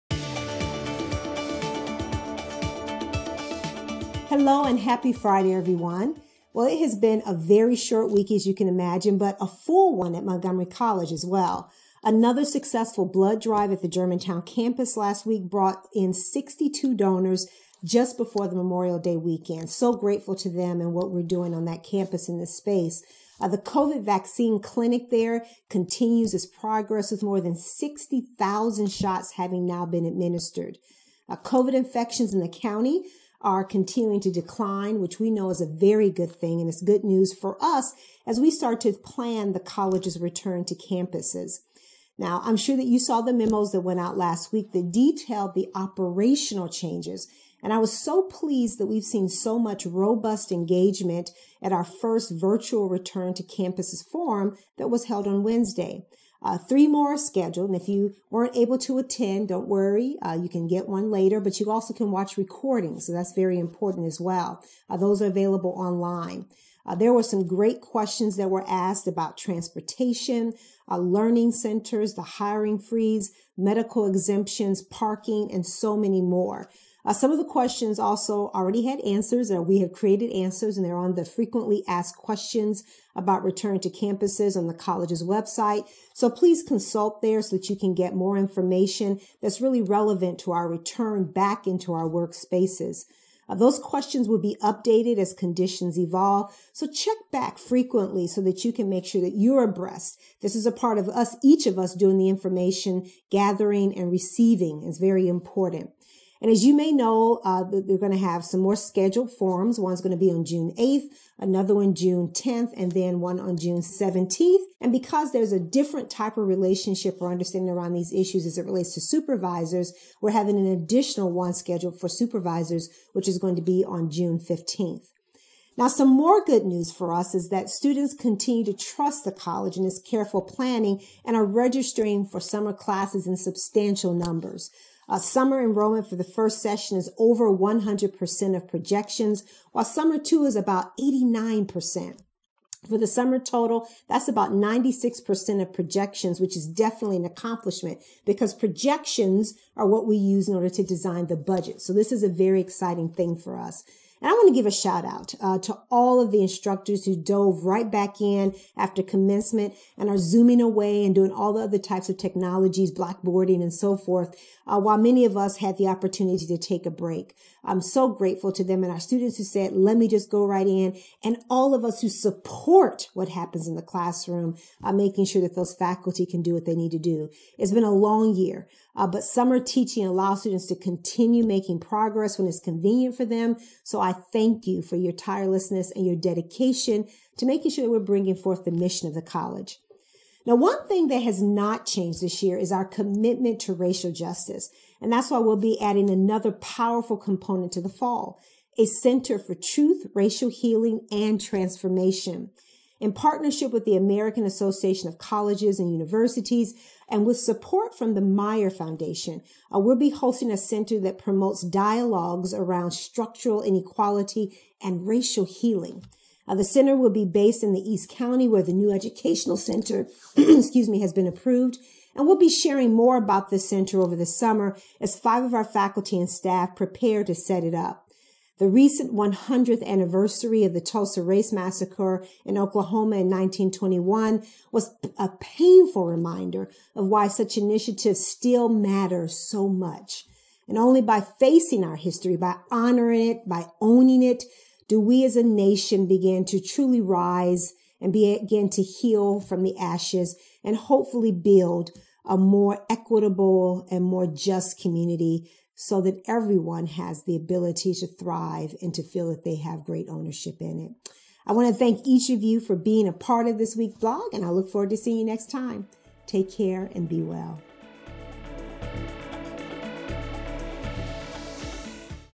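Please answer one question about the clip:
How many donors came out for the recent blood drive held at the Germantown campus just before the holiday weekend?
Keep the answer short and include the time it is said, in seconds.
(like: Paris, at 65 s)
62, at 16 s.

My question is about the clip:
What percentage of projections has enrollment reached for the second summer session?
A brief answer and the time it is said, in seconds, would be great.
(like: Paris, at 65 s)
89%, at 140 s.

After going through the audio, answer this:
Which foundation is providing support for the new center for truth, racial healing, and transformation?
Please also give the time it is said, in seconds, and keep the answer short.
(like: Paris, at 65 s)
Meyer Foundation, at 208 s.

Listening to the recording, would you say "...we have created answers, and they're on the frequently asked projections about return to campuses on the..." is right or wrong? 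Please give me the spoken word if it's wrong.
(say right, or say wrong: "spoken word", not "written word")
wrong: "questions", not "projections".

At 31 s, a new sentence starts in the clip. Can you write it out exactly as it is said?
Uh, COVID infections in the county are continuing to decline, which we know is a very good thing.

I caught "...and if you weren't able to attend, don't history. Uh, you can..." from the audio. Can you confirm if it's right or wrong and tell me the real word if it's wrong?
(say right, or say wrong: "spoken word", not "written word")
wrong: "worry", not "history".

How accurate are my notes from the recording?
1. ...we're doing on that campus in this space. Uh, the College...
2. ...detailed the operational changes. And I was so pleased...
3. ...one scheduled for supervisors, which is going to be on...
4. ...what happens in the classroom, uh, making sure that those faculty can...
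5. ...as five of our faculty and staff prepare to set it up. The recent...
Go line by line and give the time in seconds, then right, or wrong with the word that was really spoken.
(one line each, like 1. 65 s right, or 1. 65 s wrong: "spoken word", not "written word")
1. 21 s wrong: "COVID", not "College"
2. 44 s right
3. 121 s right
4. 173 s right
5. 224 s right.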